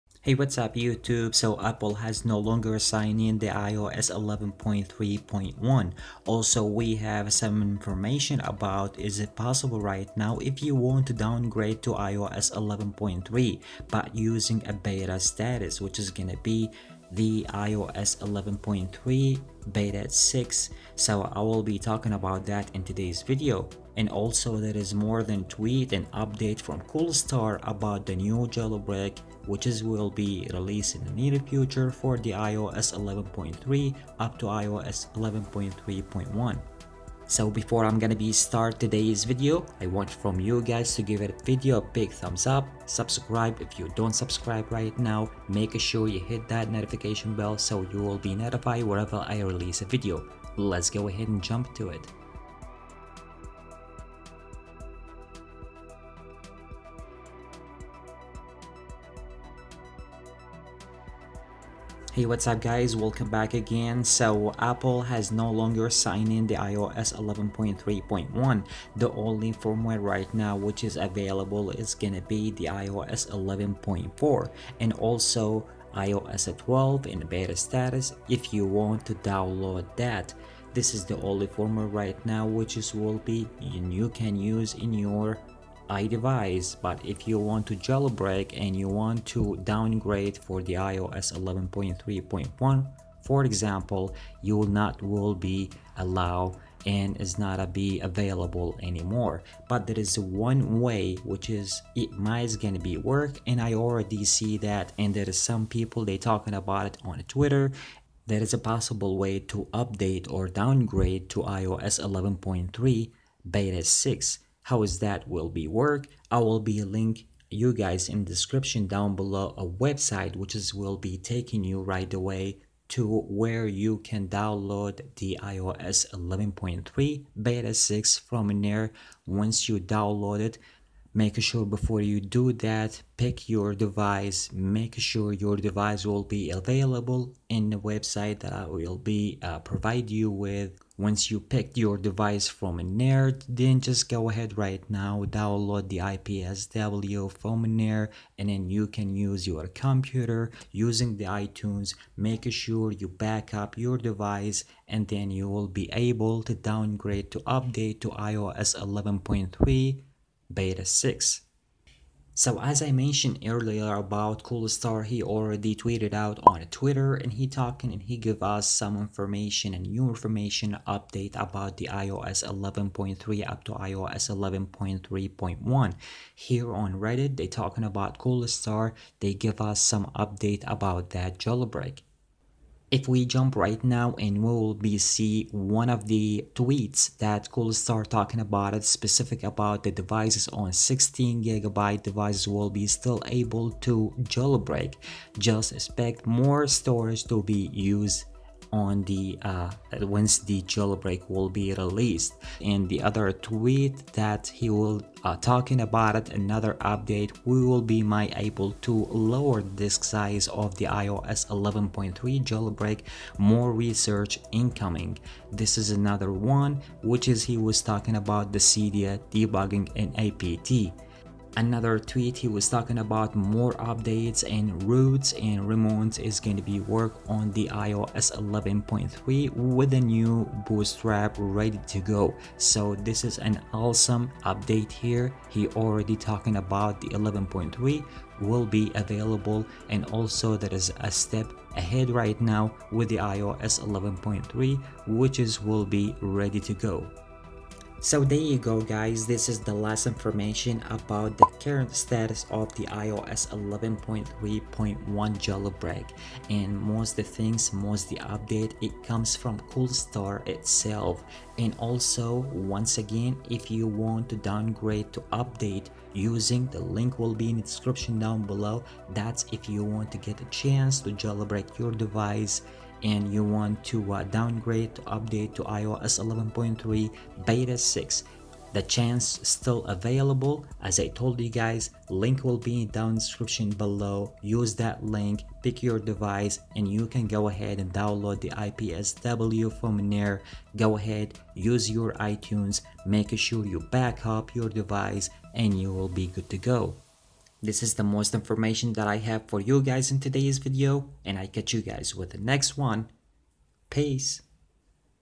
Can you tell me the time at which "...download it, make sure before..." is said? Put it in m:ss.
2:09.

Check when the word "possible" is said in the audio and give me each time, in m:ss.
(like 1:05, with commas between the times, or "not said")
0:09, 1:48.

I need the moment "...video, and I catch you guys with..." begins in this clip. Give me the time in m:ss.
5:00.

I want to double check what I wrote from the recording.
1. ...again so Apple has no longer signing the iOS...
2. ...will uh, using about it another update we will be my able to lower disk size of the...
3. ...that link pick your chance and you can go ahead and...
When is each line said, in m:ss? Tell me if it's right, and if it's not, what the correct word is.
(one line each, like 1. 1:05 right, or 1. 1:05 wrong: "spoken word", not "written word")
1. 1:03 right
2. 3:24 wrong: "talking", not "using"
3. 4:44 wrong: "device", not "chance".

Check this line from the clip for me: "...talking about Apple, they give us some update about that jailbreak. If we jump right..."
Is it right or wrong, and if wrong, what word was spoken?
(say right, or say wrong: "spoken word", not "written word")
wrong: "Coolstar", not "Apple".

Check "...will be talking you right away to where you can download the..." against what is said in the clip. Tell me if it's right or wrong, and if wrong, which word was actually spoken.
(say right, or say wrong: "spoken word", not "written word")
wrong: "taking", not "talking".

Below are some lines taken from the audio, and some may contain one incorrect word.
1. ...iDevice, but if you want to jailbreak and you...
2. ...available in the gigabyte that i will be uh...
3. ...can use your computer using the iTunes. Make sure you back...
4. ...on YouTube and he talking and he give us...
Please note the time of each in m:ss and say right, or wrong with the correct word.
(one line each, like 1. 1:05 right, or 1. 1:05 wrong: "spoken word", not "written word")
1. 1:25 right
2. 2:16 wrong: "website", not "gigabyte"
3. 2:28 right
4. 2:46 wrong: "Twitter", not "YouTube".